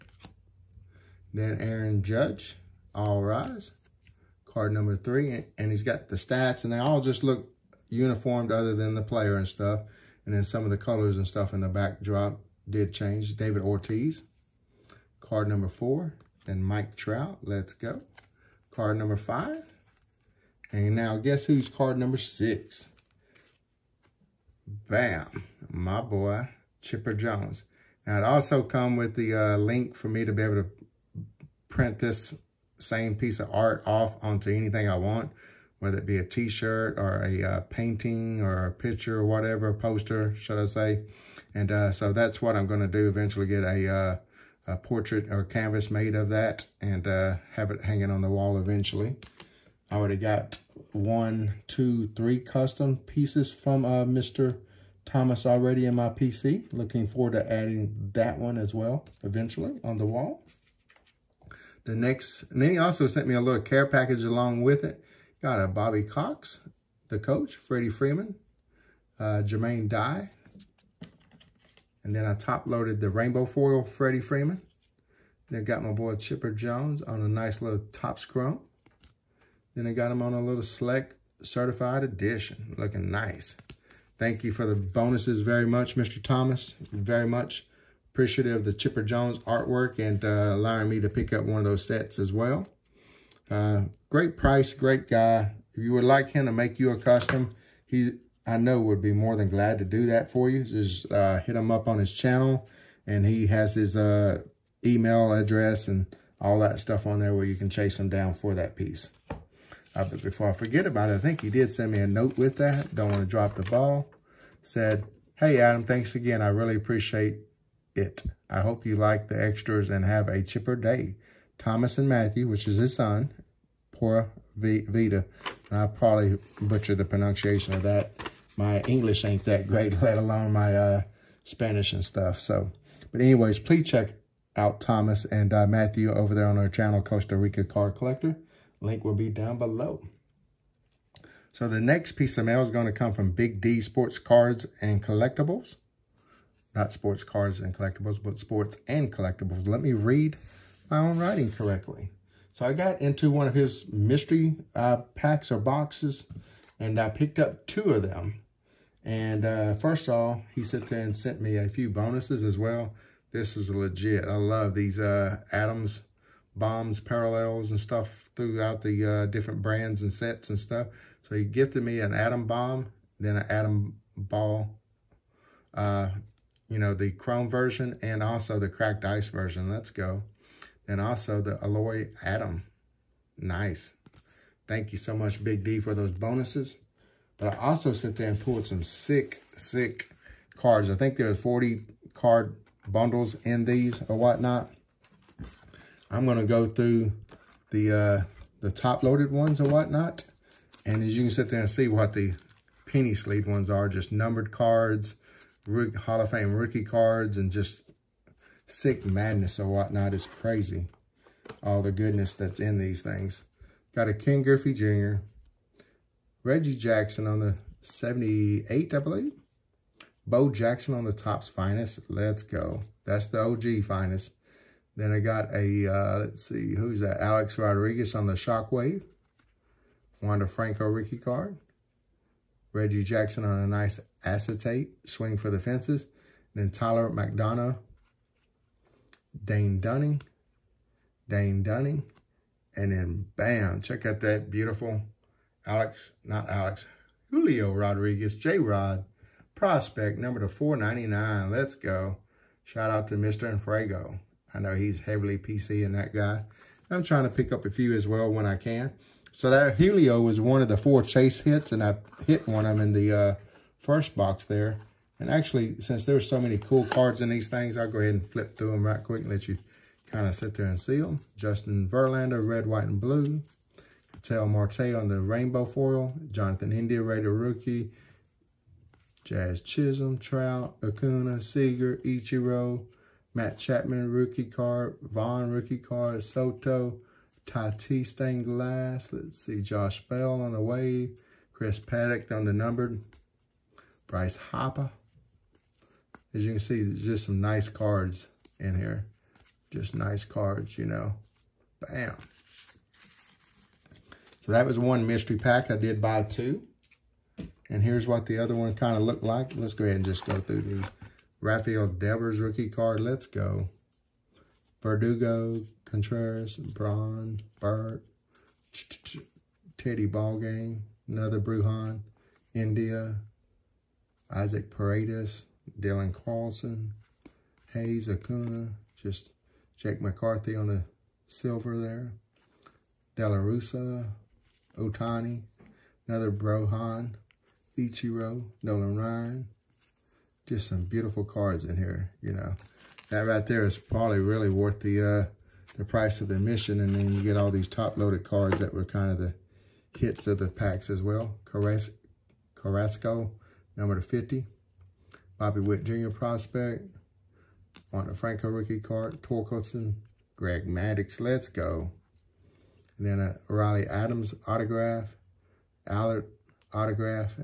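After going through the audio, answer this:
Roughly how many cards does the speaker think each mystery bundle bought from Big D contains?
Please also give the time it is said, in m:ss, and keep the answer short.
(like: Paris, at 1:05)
40, at 3:11.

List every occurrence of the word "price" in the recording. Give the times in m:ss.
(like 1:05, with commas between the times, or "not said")
1:34, 5:45.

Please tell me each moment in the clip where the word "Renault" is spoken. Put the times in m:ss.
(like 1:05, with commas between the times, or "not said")
not said.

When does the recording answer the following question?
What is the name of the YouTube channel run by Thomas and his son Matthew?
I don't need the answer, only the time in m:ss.
2:17.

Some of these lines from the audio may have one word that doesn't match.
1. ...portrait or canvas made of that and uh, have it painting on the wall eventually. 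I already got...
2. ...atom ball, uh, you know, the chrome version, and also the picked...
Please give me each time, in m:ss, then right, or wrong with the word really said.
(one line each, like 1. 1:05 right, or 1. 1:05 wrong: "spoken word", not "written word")
1. 0:44 wrong: "hanging", not "painting"
2. 2:53 wrong: "cracked", not "picked".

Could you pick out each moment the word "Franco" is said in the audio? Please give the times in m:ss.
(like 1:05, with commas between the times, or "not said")
3:50, 5:58.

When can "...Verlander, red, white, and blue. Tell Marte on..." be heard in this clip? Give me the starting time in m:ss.
4:31.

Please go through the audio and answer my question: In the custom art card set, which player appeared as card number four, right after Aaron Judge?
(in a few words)
David Ortiz.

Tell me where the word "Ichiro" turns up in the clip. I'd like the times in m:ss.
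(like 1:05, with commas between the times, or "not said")
4:42, 5:37.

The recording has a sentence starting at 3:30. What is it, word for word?
It's crazy, all the goodness that's in these things.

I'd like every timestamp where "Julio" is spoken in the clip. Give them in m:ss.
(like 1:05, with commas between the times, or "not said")
4:07, 4:19.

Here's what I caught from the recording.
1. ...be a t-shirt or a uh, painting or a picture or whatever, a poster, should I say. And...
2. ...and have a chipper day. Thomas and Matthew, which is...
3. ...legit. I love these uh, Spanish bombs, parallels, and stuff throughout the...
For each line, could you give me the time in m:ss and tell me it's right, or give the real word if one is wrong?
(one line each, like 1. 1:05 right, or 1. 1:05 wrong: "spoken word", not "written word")
1. 0:36 right
2. 1:59 right
3. 2:43 wrong: "Adams", not "Spanish".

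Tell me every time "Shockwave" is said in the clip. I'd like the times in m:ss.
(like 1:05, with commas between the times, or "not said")
3:48.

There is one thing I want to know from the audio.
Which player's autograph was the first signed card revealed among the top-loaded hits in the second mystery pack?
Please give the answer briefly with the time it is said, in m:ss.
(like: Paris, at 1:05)
Riley Adams, at 6:03.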